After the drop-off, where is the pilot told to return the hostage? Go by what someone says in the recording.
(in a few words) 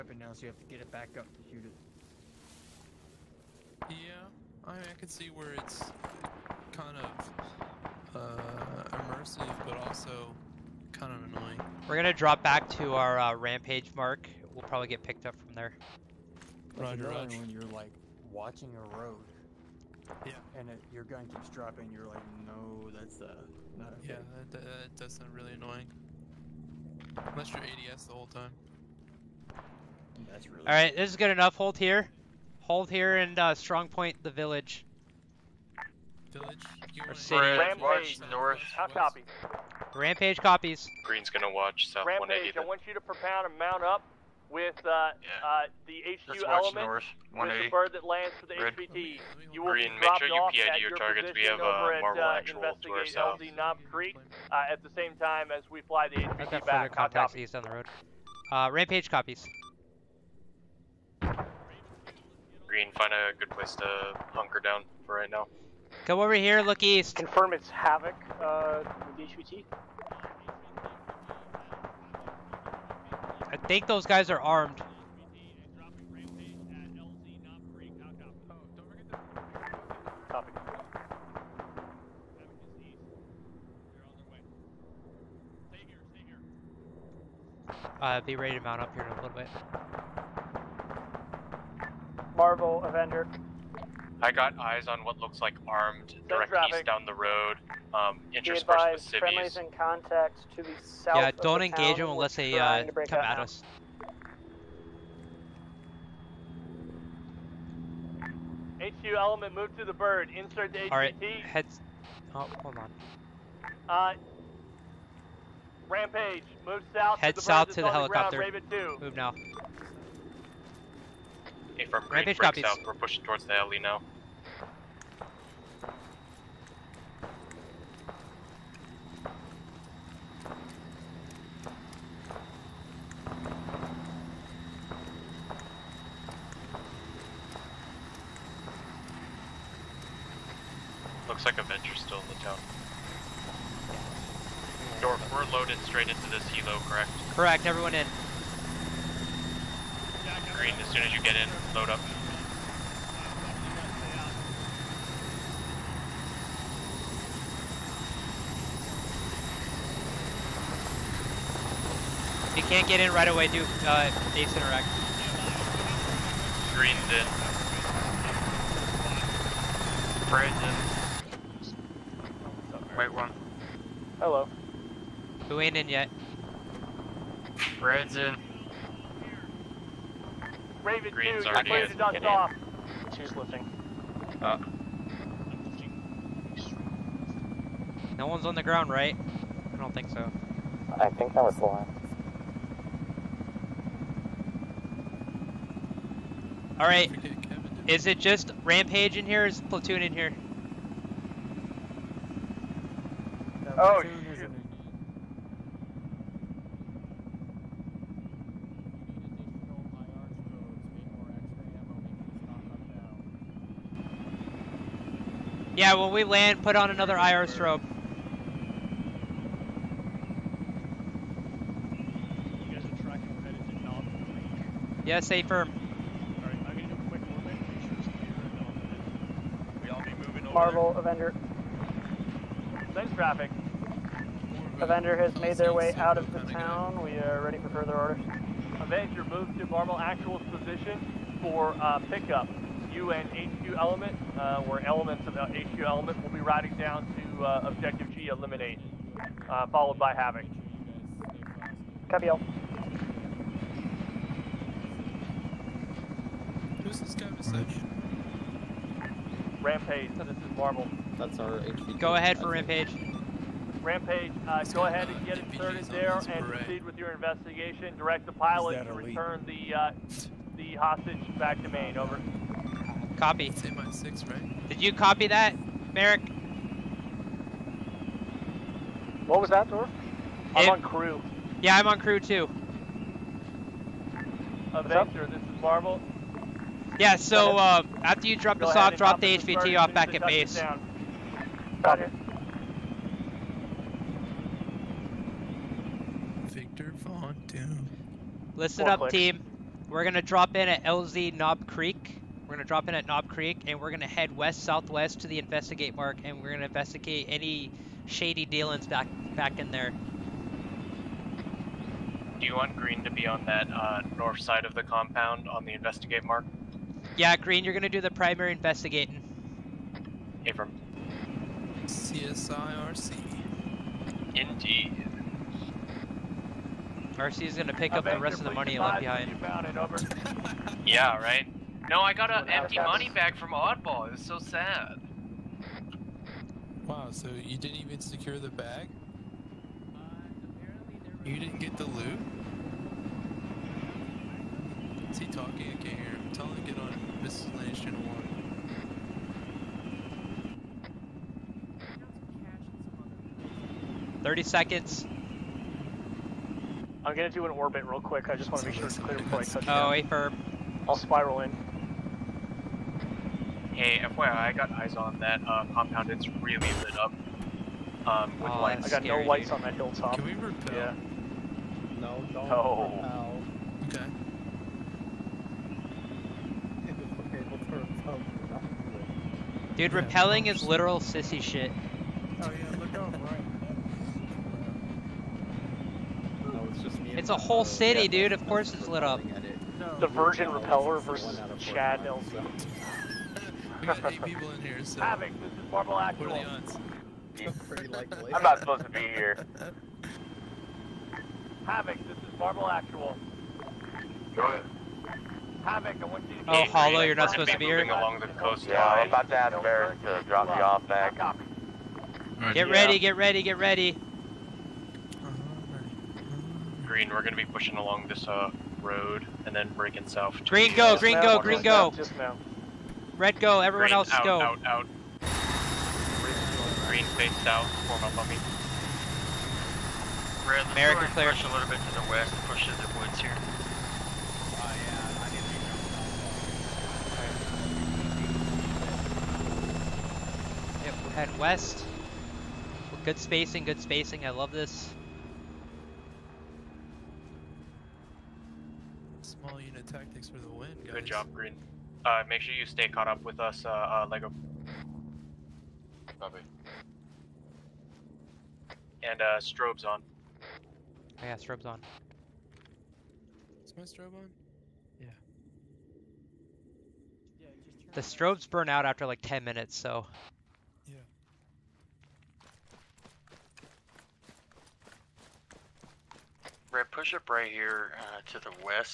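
Main.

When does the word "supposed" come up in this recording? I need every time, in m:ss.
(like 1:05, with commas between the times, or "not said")
6:38, 6:47.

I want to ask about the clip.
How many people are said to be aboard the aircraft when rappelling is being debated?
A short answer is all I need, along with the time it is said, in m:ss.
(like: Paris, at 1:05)
8, at 6:34.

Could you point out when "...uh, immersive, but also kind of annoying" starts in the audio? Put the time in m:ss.
0:08.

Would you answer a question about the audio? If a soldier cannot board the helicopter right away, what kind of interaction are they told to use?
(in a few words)
ace interact.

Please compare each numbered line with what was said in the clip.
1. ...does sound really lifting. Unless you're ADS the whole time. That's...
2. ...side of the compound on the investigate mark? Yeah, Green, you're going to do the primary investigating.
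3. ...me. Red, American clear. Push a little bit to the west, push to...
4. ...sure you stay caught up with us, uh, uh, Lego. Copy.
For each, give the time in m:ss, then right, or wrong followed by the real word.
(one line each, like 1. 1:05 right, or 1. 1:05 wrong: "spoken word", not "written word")
1. 0:25 wrong: "annoying", not "lifting"
2. 5:14 right
3. 7:08 right
4. 7:32 right.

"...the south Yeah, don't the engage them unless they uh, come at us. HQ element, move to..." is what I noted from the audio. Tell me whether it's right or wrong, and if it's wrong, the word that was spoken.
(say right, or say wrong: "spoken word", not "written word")
right.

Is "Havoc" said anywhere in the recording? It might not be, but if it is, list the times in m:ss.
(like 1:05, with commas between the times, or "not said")
1:07, 4:10, 6:35, 6:41, 6:45.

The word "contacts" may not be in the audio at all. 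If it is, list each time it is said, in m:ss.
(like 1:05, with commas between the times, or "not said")
0:56, 1:39.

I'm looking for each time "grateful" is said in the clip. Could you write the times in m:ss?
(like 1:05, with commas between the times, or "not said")
not said.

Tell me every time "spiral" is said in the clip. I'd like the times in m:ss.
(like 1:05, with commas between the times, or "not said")
6:00.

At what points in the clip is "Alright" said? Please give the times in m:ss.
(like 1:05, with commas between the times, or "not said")
3:16, 3:46.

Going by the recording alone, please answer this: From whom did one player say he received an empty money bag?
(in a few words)
Oddball.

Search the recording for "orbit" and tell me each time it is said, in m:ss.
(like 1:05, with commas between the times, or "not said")
3:47, 5:57.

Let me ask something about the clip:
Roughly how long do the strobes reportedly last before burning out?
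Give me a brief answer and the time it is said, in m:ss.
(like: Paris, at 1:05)
10 minutes, at 7:49.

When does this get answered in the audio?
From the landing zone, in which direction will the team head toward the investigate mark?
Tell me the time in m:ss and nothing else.
5:04.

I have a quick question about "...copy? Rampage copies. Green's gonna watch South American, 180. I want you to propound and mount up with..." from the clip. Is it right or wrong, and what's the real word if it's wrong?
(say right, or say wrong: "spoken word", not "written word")
wrong: "Rampage", not "American".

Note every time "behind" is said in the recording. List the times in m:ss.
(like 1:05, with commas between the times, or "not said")
5:28.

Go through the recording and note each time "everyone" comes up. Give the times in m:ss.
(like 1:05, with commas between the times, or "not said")
2:27, 7:03.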